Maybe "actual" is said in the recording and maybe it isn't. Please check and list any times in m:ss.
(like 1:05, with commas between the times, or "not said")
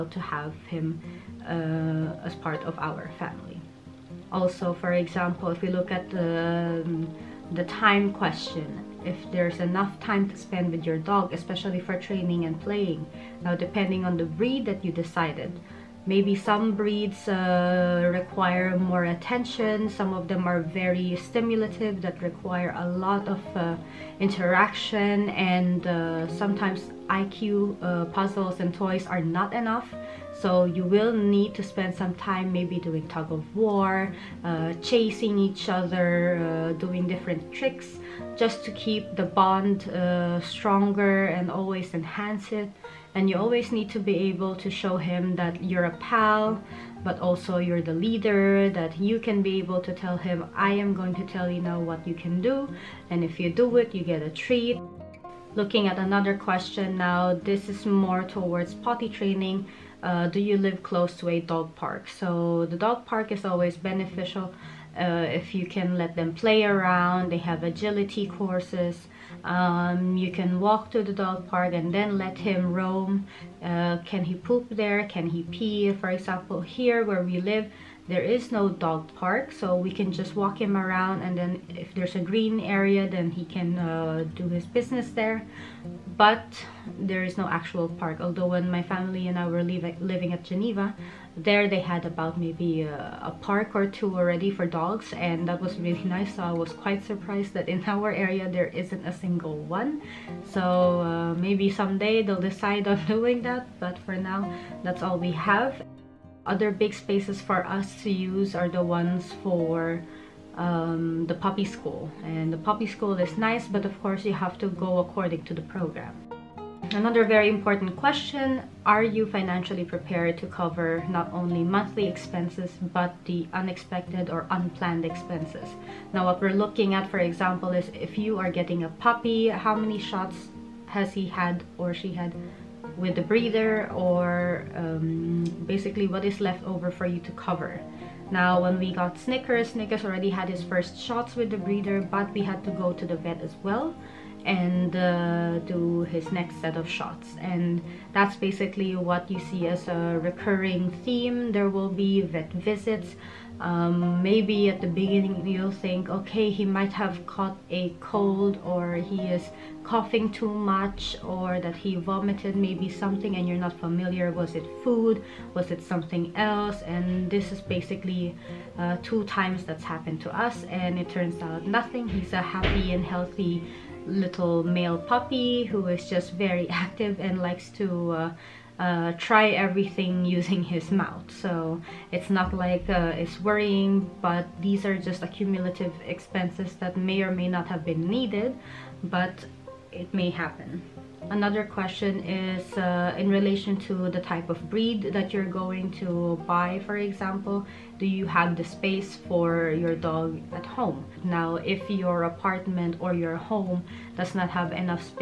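1:27.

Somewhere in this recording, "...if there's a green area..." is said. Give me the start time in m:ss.
1:21.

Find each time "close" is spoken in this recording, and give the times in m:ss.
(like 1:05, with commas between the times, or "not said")
1:00.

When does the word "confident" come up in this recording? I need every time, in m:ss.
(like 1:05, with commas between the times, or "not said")
not said.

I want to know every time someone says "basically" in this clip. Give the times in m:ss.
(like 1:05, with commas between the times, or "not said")
2:15, 2:28, 2:47.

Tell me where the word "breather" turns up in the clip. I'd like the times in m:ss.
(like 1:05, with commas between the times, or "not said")
2:13.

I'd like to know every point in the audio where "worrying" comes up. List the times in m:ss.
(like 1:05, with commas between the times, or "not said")
3:03.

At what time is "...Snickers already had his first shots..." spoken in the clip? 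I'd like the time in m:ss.
2:19.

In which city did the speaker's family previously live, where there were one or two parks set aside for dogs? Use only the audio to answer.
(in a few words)
Geneva.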